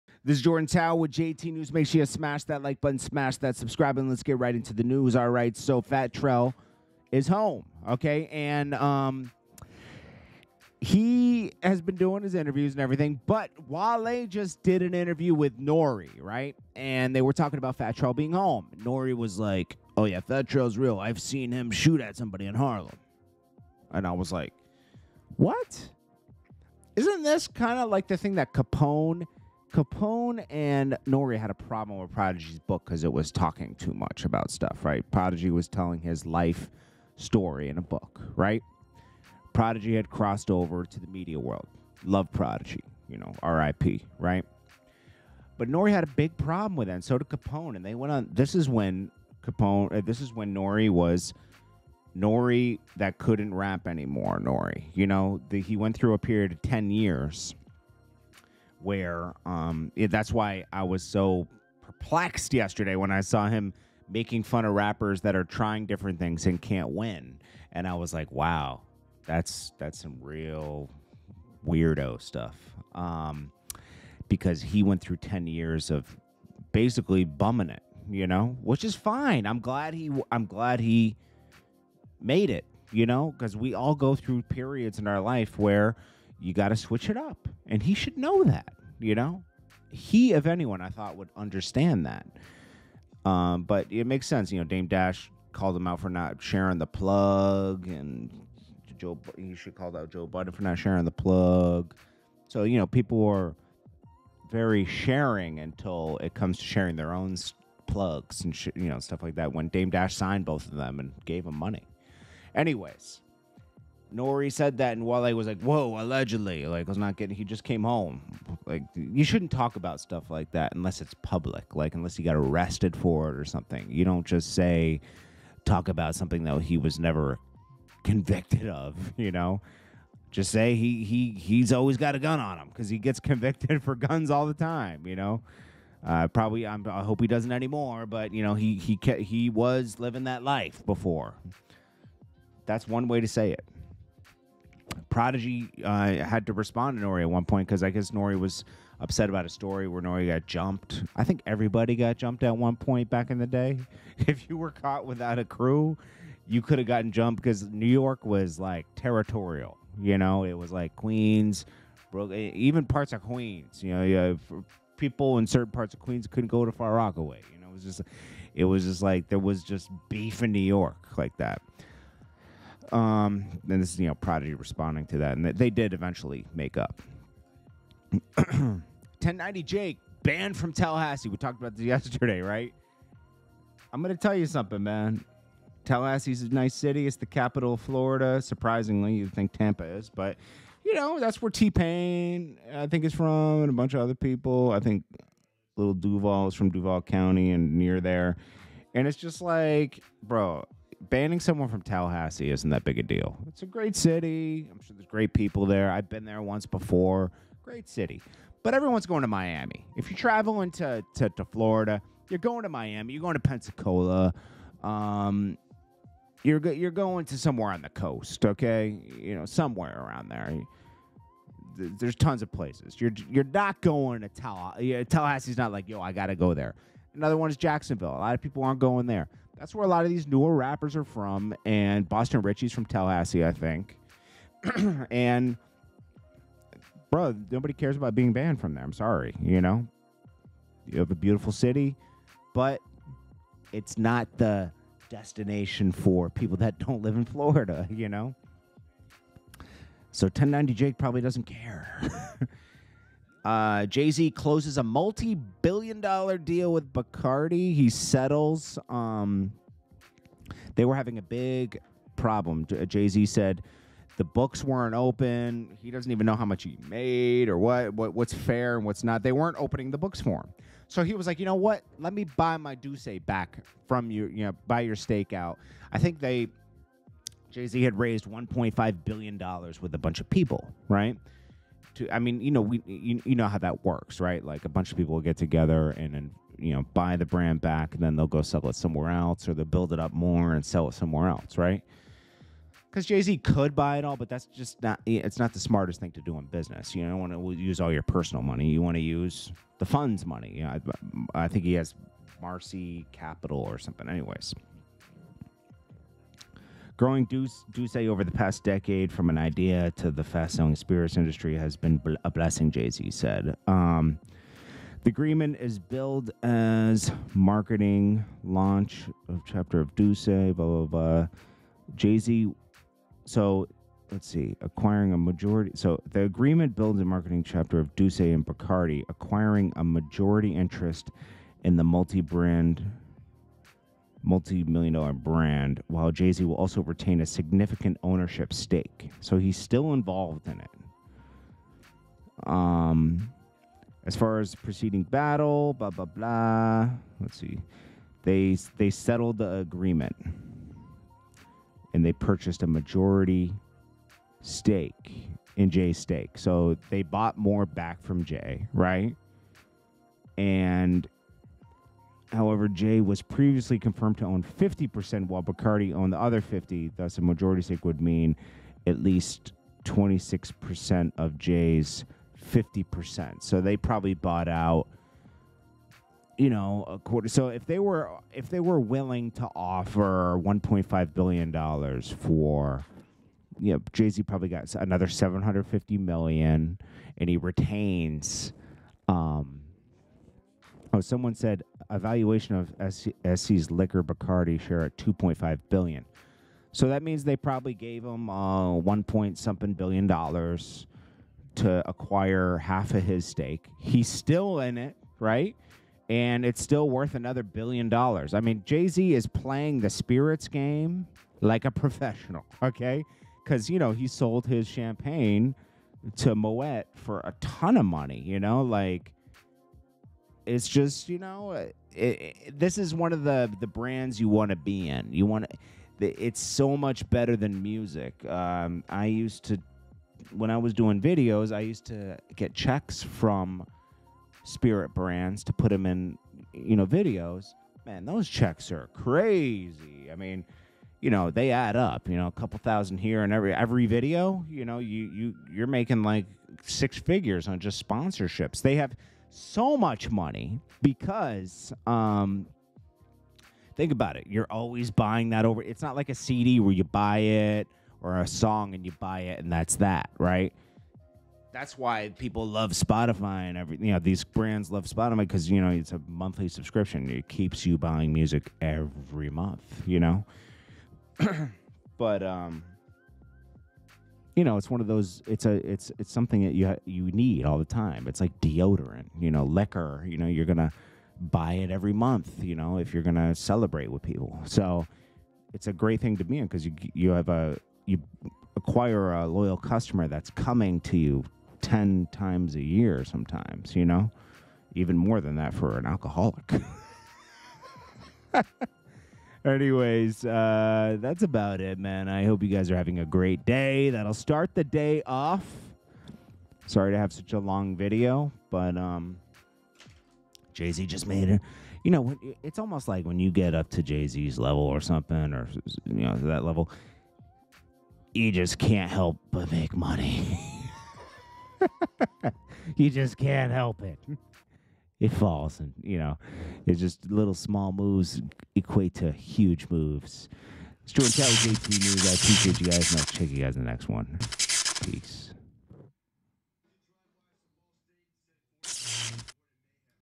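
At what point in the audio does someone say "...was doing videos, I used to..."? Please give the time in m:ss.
7:10.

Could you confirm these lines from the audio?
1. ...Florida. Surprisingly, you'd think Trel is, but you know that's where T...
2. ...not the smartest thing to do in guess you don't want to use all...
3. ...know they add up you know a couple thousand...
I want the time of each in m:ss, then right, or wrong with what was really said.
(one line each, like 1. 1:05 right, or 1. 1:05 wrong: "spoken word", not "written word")
1. 3:07 wrong: "Tampa", not "Trel"
2. 4:55 wrong: "business", not "guess"
3. 7:21 right.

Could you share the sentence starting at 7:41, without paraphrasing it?
That's why people love Spotify and every you know these brands love Spotify because you know it's a monthly subscription.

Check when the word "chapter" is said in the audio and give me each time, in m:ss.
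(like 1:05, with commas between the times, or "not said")
5:19, 5:27.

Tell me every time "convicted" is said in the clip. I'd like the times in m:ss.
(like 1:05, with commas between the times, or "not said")
2:08, 2:13.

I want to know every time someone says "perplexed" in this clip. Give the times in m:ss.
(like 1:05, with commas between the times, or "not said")
1:01.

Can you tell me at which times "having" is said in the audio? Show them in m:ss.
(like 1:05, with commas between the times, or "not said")
4:20, 8:22.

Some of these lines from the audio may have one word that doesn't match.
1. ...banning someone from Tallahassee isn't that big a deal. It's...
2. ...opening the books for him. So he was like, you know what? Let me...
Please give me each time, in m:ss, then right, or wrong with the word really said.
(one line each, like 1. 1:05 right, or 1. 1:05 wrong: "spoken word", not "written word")
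1. 3:21 right
2. 4:29 right.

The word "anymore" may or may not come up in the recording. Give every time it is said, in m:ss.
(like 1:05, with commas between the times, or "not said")
0:53, 2:17.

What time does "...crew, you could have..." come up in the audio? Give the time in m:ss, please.
2:35.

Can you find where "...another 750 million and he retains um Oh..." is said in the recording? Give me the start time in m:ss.
6:24.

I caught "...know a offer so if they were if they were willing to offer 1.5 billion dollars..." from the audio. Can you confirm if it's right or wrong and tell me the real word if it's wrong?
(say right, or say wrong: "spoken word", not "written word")
wrong: "quarter", not "offer".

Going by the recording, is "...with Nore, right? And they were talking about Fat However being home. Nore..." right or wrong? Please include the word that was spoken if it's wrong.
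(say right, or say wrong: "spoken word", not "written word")
wrong: "Trel", not "However".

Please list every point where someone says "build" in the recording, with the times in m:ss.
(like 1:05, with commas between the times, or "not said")
4:49, 5:26.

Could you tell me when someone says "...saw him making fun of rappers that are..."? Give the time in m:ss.
1:03.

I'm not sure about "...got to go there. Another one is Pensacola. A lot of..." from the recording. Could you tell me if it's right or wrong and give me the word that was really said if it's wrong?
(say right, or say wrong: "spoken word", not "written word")
wrong: "Jacksonville", not "Pensacola".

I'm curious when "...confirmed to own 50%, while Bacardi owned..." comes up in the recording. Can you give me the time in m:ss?
6:03.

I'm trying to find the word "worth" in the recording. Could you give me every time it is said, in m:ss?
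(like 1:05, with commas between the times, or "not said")
6:46.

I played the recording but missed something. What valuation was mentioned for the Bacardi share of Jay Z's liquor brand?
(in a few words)
$2.5 billion.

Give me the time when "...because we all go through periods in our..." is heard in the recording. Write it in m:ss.
1:23.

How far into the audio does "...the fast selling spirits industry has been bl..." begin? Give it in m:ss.
5:10.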